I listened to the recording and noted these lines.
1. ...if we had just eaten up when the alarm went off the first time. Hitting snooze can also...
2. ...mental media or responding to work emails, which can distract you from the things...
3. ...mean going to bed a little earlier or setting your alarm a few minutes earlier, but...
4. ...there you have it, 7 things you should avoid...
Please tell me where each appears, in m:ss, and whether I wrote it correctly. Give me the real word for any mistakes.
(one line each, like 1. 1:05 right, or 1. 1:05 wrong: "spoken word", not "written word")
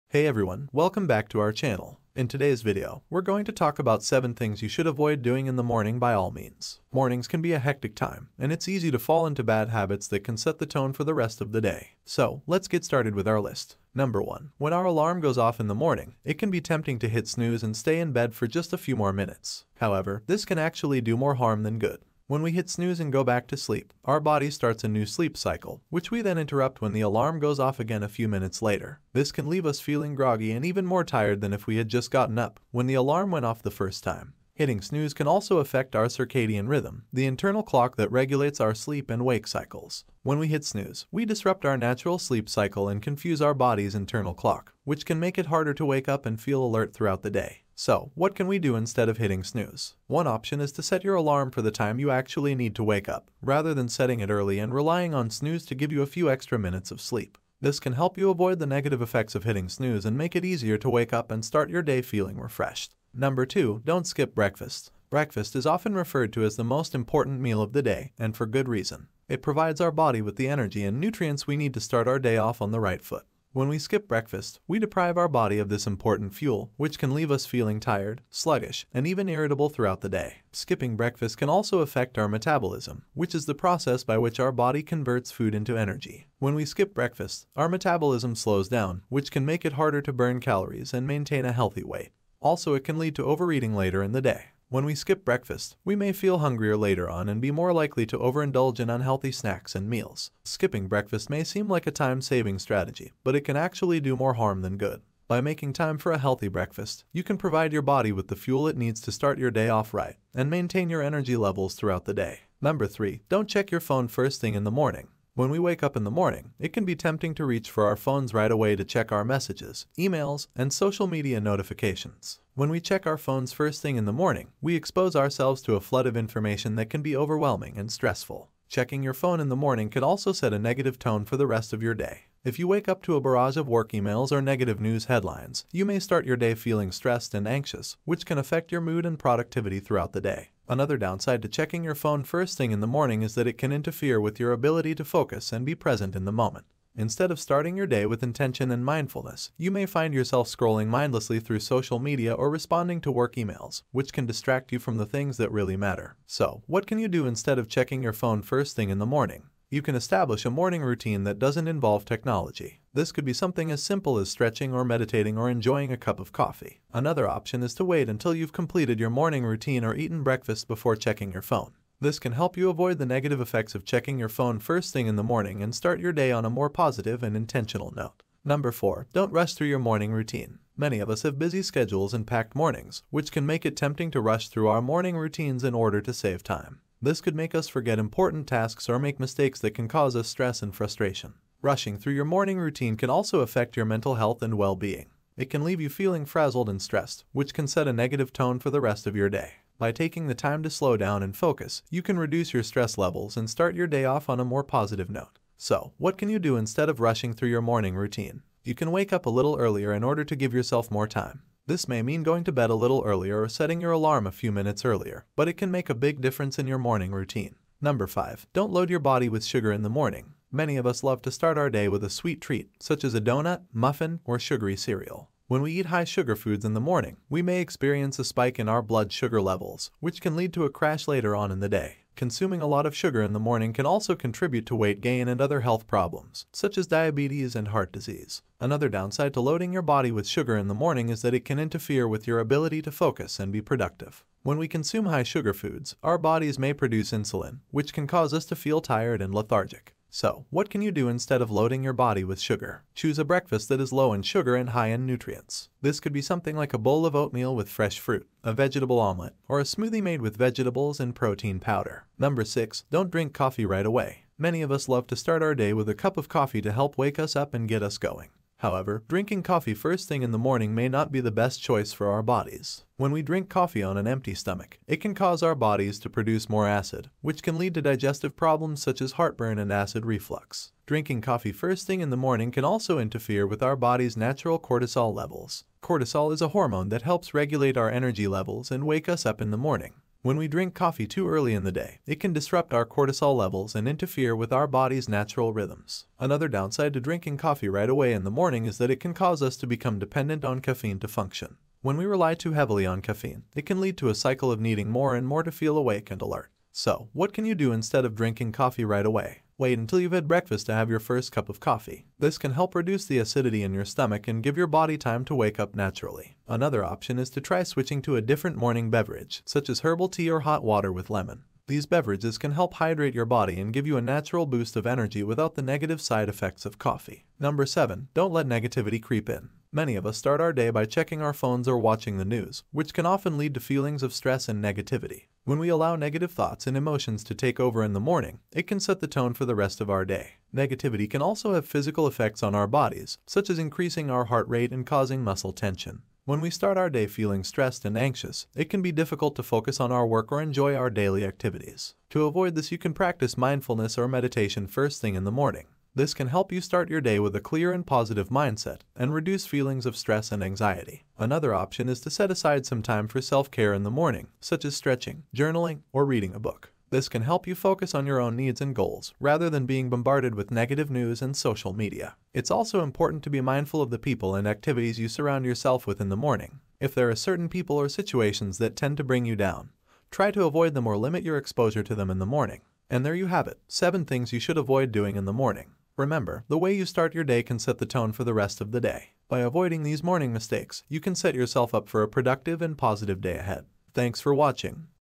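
1. 0:31 wrong: "gotten", not "eaten"
2. 2:31 wrong: "social", not "mental"
3. 3:32 right
4. 6:23 right.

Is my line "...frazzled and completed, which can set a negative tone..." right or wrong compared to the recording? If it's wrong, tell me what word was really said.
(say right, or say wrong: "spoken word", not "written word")
wrong: "stressed", not "completed".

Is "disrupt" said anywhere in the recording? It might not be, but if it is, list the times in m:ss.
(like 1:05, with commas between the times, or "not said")
0:41, 4:52.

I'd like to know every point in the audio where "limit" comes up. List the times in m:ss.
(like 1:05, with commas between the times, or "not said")
6:20.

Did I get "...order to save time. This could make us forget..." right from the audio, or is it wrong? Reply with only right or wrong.
right.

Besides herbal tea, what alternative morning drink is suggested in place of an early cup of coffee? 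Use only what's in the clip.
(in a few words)
hot water with lemon.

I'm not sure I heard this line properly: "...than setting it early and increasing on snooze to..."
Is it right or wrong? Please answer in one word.
wrong.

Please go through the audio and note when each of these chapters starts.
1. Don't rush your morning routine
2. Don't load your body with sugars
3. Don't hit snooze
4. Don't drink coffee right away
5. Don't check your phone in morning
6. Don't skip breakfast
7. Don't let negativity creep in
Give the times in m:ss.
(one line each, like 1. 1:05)
1. 2:58
2. 3:38
3. 0:13
4. 4:22
5. 1:53
6. 1:03
7. 5:28.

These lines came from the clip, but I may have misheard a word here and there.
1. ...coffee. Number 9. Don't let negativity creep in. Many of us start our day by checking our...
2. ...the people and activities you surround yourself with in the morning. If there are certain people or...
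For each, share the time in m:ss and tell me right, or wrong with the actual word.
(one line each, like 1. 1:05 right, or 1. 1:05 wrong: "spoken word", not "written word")
1. 5:26 wrong: "7", not "9"
2. 6:13 right.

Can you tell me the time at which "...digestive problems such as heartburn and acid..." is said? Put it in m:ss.
4:37.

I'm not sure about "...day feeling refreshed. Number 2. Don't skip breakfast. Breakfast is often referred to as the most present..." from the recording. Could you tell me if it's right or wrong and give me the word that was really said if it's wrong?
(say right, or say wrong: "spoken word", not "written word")
wrong: "important", not "present".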